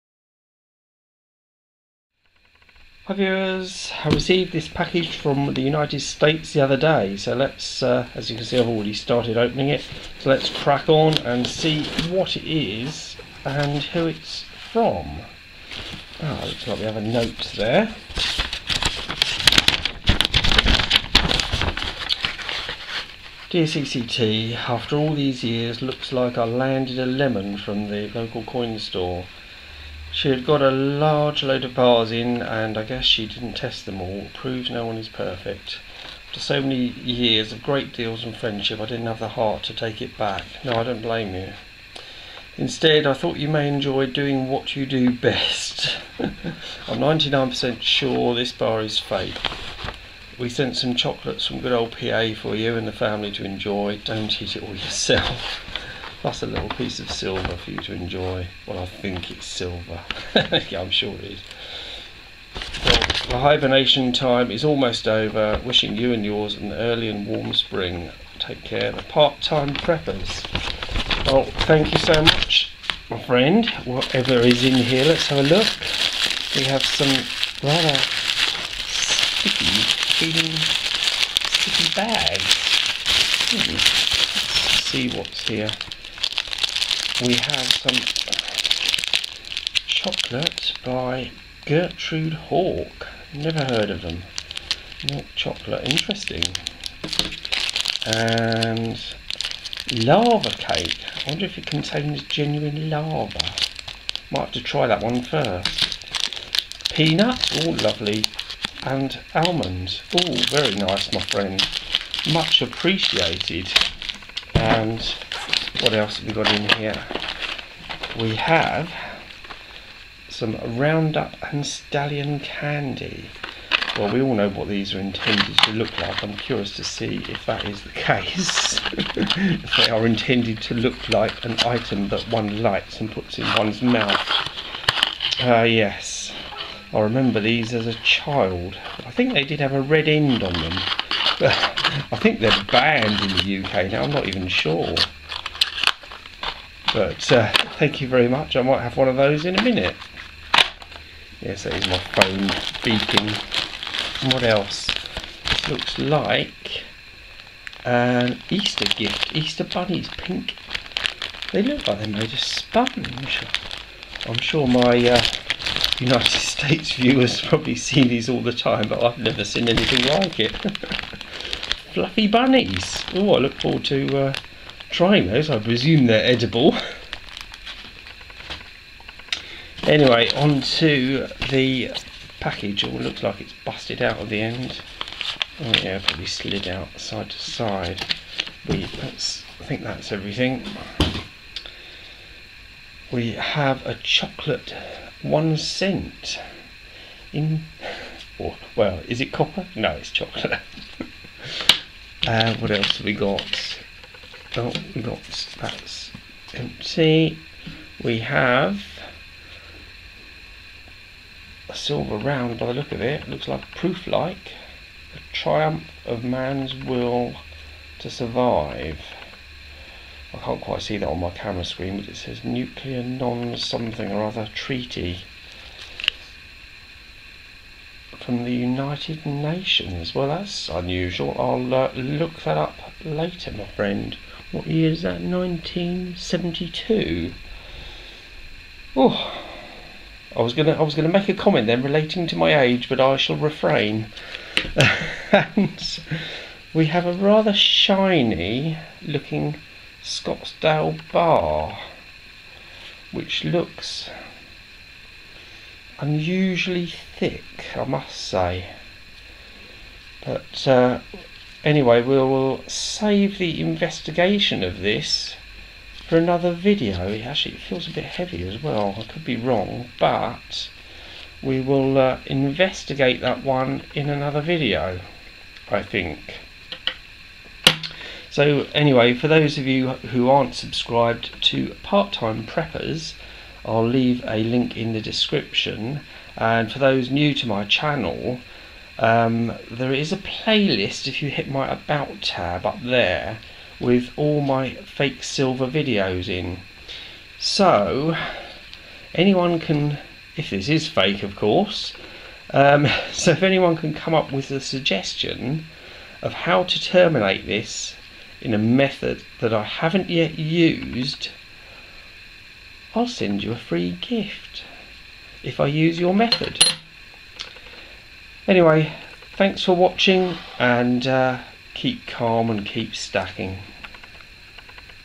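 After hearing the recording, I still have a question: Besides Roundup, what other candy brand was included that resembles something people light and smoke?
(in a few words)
Stallion.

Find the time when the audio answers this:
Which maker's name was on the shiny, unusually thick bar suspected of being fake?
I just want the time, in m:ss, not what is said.
4:10.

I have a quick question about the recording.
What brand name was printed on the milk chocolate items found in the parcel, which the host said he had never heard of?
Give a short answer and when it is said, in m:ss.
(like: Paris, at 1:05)
Gertrude Hawk, at 1:31.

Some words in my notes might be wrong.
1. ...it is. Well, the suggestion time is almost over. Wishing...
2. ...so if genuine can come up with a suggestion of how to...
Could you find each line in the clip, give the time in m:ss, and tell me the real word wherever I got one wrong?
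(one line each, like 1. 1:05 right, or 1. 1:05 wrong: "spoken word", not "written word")
1. 1:01 wrong: "hibernation", not "suggestion"
2. 5:03 wrong: "anyone", not "genuine".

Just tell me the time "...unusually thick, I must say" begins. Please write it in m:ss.
4:16.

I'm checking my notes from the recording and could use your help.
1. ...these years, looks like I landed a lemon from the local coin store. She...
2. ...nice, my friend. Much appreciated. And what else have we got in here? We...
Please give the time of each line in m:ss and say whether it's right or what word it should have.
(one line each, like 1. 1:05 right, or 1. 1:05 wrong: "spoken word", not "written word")
1. 0:25 right
2. 1:50 right.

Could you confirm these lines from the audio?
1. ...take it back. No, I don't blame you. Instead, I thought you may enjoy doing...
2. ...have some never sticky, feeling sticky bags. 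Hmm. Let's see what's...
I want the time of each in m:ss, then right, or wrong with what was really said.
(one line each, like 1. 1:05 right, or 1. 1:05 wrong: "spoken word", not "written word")
1. 0:39 right
2. 1:16 wrong: "rather", not "never".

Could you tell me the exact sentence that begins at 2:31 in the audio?
Yes, that is my phone beeping.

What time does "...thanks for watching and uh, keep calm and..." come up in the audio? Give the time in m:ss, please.
5:19.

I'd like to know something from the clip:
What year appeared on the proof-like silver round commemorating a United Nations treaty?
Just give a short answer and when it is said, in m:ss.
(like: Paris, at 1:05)
1972, at 3:55.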